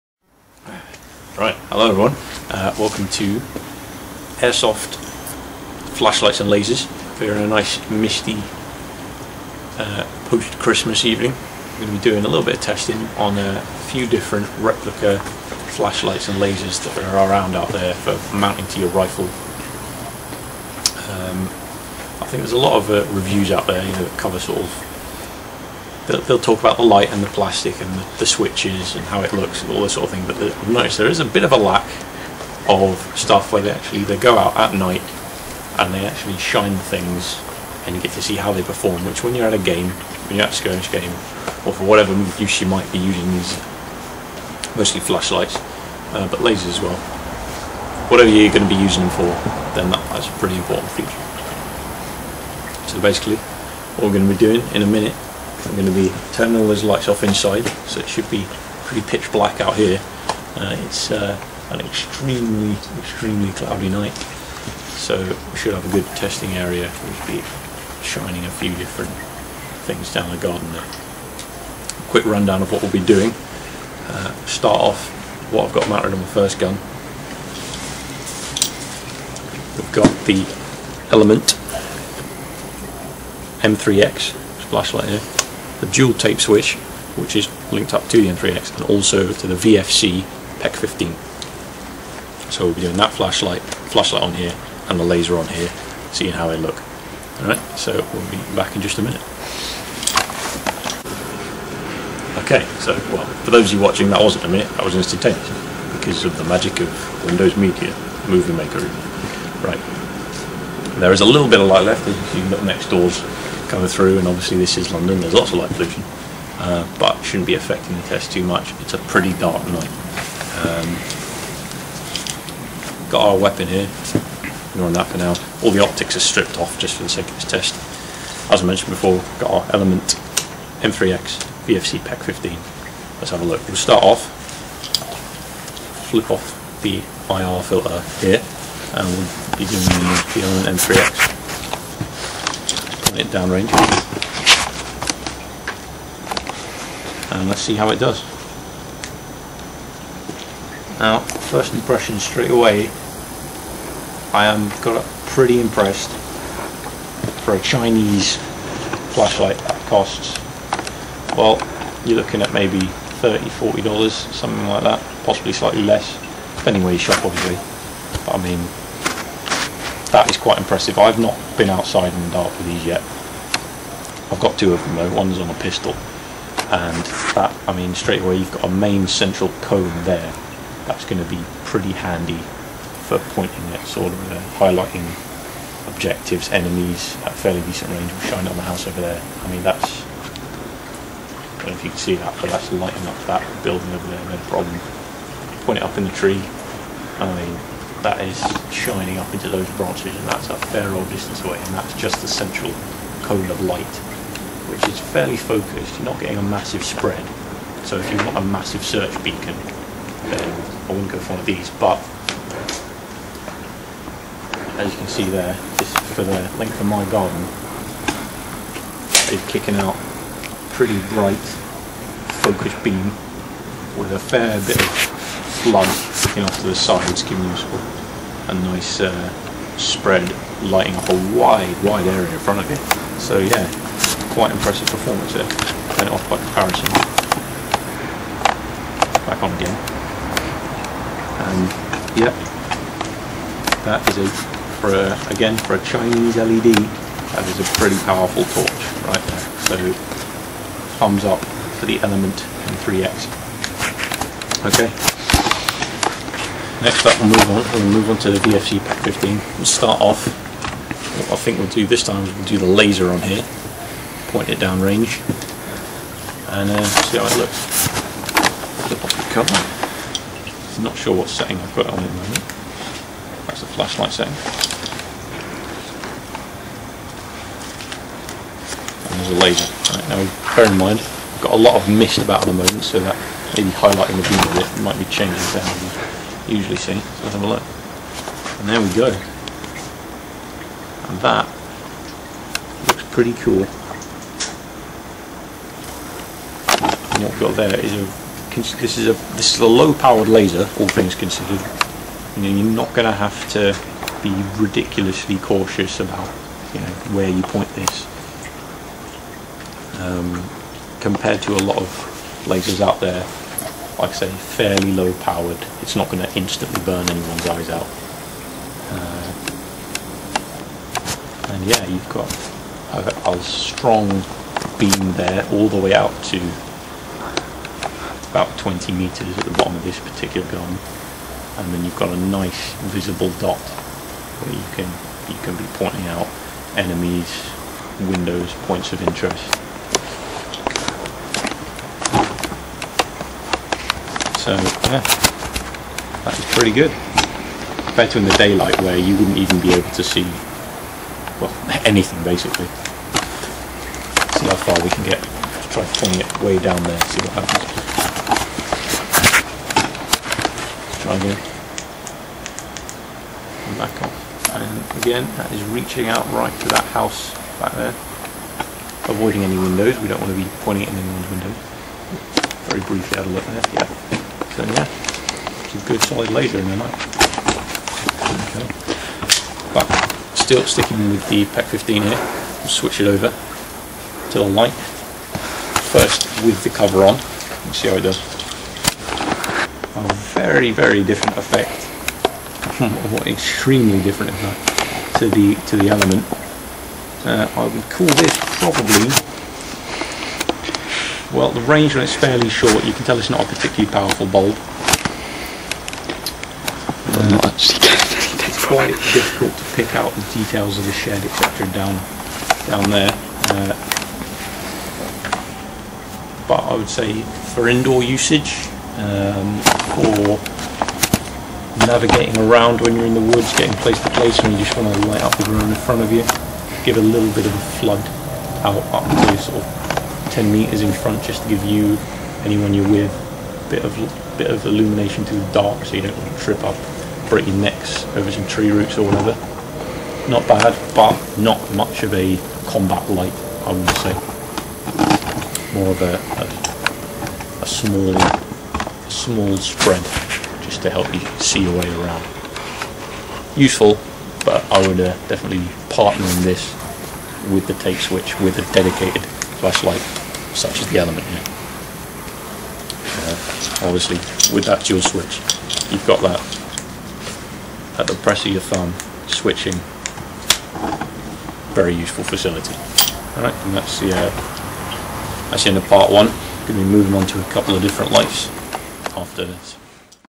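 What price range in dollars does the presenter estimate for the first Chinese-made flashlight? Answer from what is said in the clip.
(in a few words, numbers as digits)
30-40 dollars.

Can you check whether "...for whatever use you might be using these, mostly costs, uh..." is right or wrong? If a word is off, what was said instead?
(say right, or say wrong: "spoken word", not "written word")
wrong: "flashlights", not "costs".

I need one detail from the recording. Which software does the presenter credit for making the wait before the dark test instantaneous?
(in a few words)
Windows Media Movie Maker.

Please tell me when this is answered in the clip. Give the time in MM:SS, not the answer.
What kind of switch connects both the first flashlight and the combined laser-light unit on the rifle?
01:25.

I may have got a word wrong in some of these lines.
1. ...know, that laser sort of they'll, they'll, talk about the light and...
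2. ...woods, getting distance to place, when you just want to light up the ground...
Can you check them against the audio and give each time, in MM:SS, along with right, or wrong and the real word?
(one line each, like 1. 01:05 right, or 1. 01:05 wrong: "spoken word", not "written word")
1. 00:23 wrong: "cover", not "laser"
2. 07:03 wrong: "place", not "distance".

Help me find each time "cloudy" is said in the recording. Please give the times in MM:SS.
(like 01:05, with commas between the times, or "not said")
01:03.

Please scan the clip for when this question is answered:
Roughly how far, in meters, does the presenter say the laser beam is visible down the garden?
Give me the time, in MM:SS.
05:28.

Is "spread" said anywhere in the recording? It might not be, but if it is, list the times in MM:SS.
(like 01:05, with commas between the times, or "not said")
03:26, 03:49, 07:29.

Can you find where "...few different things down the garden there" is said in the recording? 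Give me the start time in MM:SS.
01:08.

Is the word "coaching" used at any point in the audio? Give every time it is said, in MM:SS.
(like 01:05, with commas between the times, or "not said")
not said.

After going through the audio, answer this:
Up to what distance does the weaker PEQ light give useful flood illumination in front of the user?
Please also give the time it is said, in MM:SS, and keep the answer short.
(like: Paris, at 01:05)
10 meters, at 07:10.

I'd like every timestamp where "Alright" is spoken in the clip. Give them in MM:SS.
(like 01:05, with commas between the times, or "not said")
01:37, 07:53.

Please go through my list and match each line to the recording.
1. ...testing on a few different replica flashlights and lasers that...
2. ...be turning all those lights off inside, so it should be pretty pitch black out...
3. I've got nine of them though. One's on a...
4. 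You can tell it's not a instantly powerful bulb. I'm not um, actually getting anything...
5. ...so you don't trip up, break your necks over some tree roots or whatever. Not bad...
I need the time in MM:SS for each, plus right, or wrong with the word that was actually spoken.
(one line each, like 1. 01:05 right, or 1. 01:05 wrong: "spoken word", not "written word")
1. 00:12 right
2. 00:55 right
3. 02:54 wrong: "two", not "nine"
4. 06:42 wrong: "particularly", not "instantly"
5. 07:15 right.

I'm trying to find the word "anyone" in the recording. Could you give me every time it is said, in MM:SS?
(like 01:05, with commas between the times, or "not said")
05:17, 06:10, 07:12.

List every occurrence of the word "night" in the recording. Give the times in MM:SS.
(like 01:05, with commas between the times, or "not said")
00:34, 01:03, 01:59, 06:16.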